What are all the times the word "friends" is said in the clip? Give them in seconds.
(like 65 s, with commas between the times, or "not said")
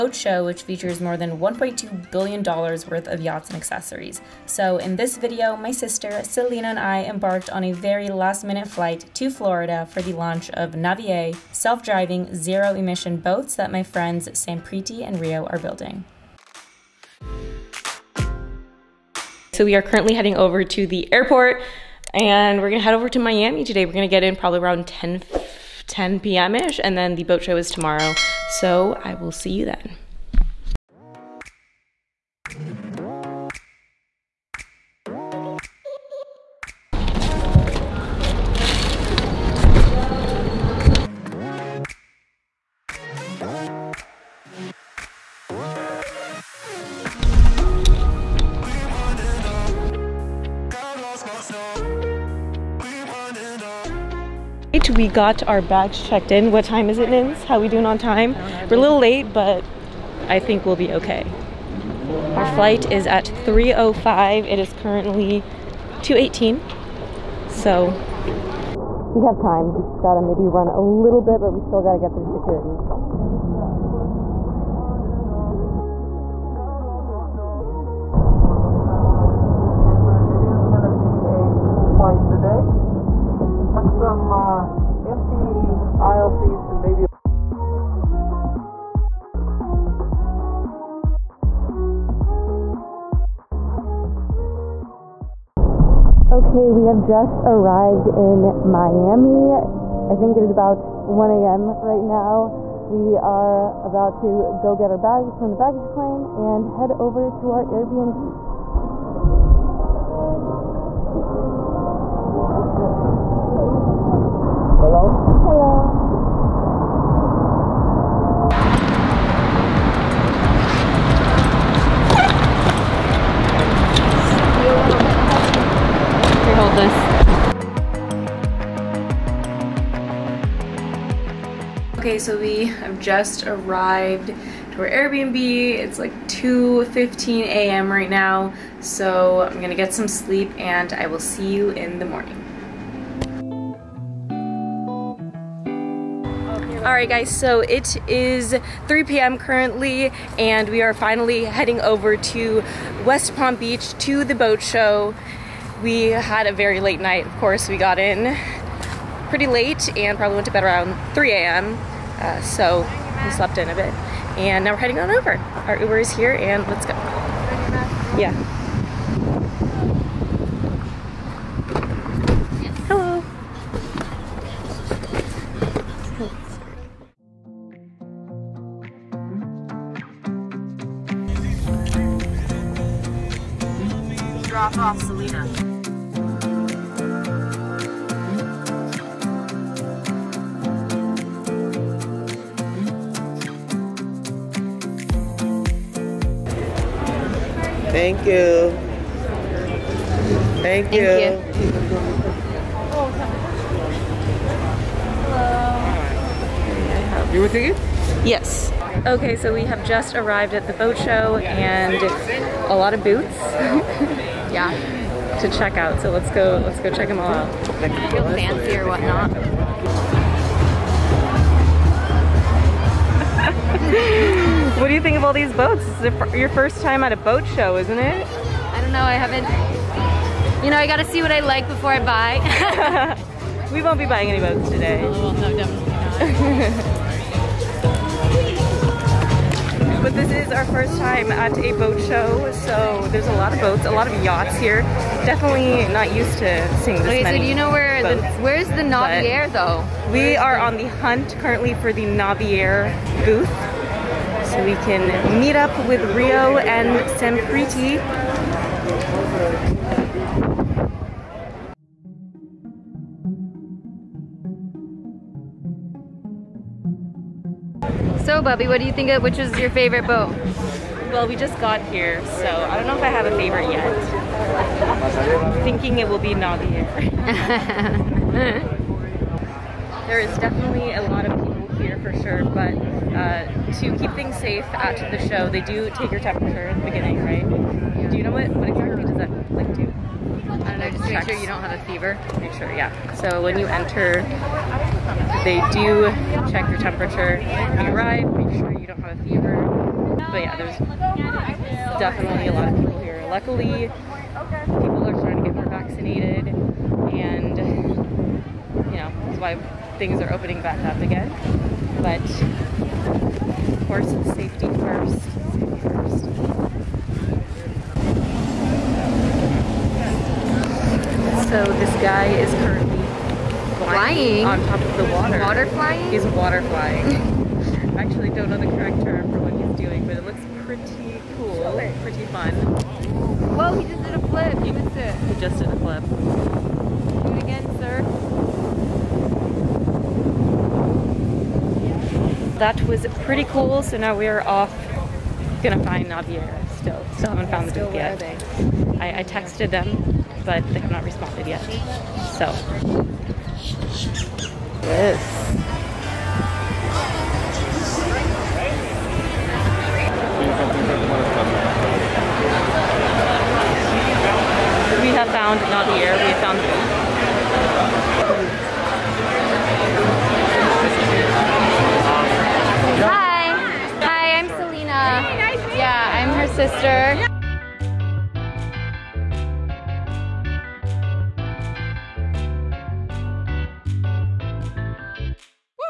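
13 s.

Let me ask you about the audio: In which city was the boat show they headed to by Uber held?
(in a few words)
West Palm Beach.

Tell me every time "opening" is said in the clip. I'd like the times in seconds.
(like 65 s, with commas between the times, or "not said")
310 s.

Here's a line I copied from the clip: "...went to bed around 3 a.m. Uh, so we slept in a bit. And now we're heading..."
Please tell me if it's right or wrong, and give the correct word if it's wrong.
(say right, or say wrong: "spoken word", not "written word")
right.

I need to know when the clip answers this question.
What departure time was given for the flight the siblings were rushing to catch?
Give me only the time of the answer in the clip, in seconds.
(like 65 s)
63 s.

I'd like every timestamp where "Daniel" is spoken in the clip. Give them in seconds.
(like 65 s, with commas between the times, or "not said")
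not said.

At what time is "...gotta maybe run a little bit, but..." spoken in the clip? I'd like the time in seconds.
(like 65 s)
70 s.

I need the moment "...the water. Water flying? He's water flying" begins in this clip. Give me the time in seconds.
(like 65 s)
324 s.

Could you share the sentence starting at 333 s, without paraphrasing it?
Whoa, he just did a flip.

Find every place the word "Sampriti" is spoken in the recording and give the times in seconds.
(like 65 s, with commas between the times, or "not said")
14 s, 257 s.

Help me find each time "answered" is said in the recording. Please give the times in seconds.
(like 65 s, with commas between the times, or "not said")
not said.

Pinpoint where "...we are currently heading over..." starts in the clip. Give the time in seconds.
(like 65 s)
19 s.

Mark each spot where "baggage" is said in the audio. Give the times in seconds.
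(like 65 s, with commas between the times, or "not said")
105 s.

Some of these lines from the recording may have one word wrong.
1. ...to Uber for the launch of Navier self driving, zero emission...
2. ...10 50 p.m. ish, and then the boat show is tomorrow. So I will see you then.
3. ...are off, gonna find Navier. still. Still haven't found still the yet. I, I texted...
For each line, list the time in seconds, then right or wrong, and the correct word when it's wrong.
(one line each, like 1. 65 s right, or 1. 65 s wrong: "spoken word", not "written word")
1. 9 s wrong: "Florida", not "Uber"
2. 24 s wrong: "10", not "50"
3. 344 s right.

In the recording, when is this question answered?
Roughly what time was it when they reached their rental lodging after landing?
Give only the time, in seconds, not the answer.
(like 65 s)
136 s.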